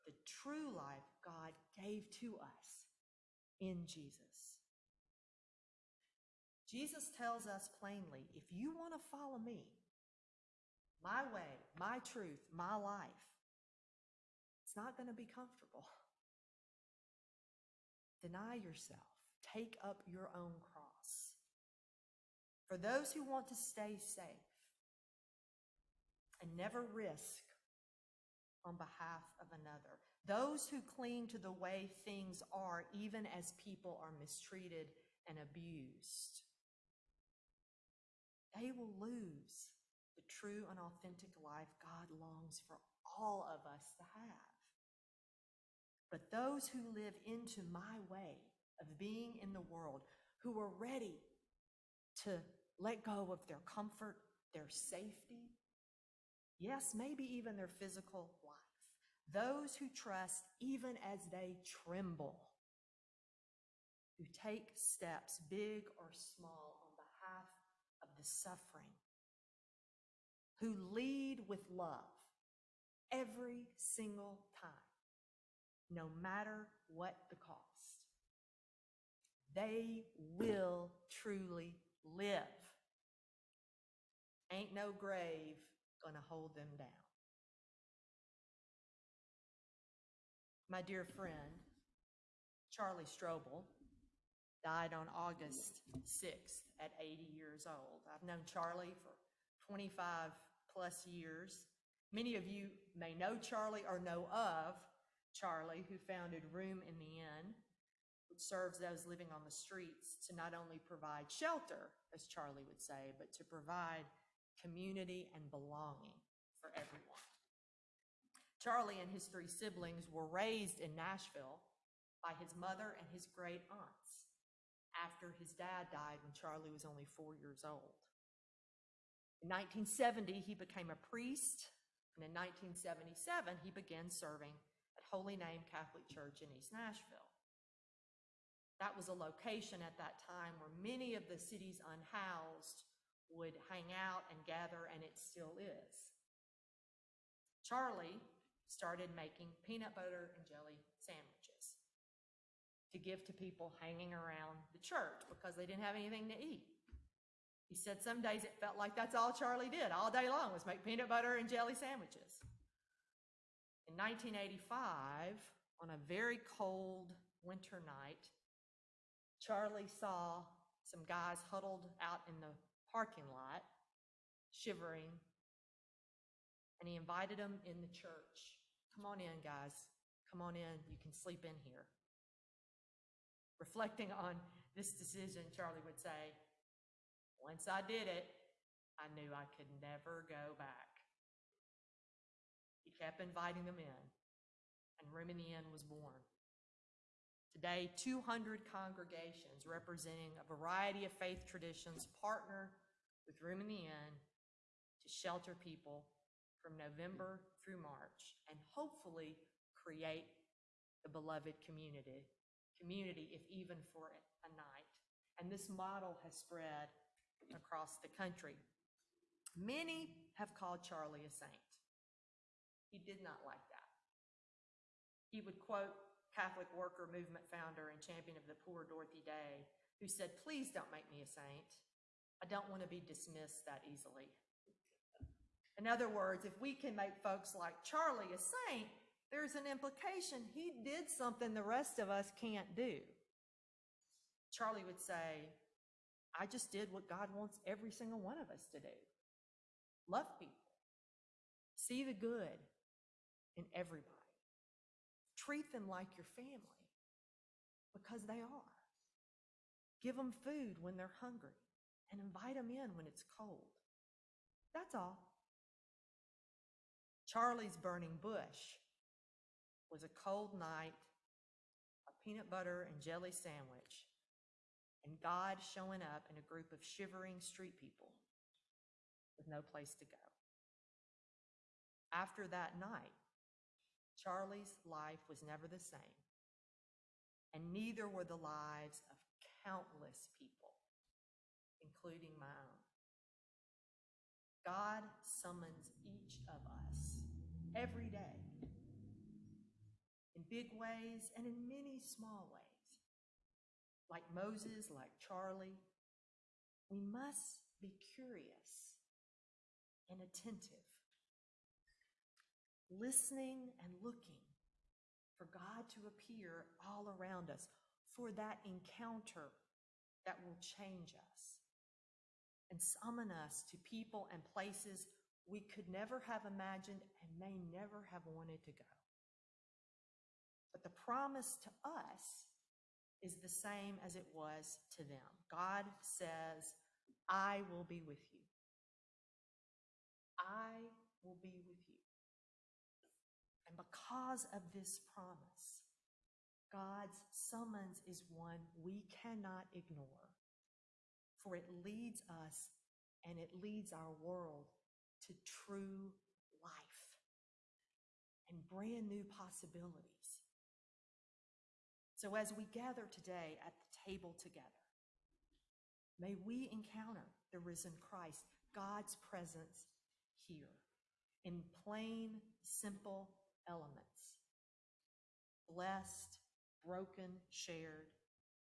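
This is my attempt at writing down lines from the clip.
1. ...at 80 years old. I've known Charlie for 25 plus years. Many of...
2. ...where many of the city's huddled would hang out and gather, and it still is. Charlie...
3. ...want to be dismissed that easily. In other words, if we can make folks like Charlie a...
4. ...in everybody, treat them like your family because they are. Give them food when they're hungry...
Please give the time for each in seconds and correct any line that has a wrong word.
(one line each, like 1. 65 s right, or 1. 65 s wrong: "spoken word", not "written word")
1. 96 s right
2. 140 s wrong: "unhoused", not "huddled"
3. 232 s right
4. 253 s right.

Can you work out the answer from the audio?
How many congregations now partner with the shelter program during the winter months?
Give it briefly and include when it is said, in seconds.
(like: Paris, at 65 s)
200, at 197 s.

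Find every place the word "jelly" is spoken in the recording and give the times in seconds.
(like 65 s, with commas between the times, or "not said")
150 s, 161 s, 273 s.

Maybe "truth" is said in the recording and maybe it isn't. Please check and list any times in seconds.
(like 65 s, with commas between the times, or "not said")
12 s.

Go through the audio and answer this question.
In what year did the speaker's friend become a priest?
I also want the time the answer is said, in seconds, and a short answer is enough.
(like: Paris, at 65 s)
1970, at 129 s.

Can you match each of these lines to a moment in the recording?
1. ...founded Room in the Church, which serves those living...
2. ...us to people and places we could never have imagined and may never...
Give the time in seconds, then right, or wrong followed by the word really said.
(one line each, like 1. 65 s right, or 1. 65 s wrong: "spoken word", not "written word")
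1. 106 s wrong: "Inn", not "Church"
2. 323 s right.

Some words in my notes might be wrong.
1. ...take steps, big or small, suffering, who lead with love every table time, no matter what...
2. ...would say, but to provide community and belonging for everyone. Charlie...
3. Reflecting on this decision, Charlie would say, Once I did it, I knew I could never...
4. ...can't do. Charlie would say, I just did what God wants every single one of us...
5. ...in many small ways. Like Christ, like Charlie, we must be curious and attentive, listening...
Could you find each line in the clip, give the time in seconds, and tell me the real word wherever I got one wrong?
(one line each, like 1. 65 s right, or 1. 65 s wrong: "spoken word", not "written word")
1. 64 s wrong: "single", not "table"
2. 112 s right
3. 183 s right
4. 242 s right
5. 301 s wrong: "Moses", not "Christ".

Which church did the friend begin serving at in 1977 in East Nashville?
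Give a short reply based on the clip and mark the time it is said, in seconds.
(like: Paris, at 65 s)
Holy Name Catholic Church, at 135 s.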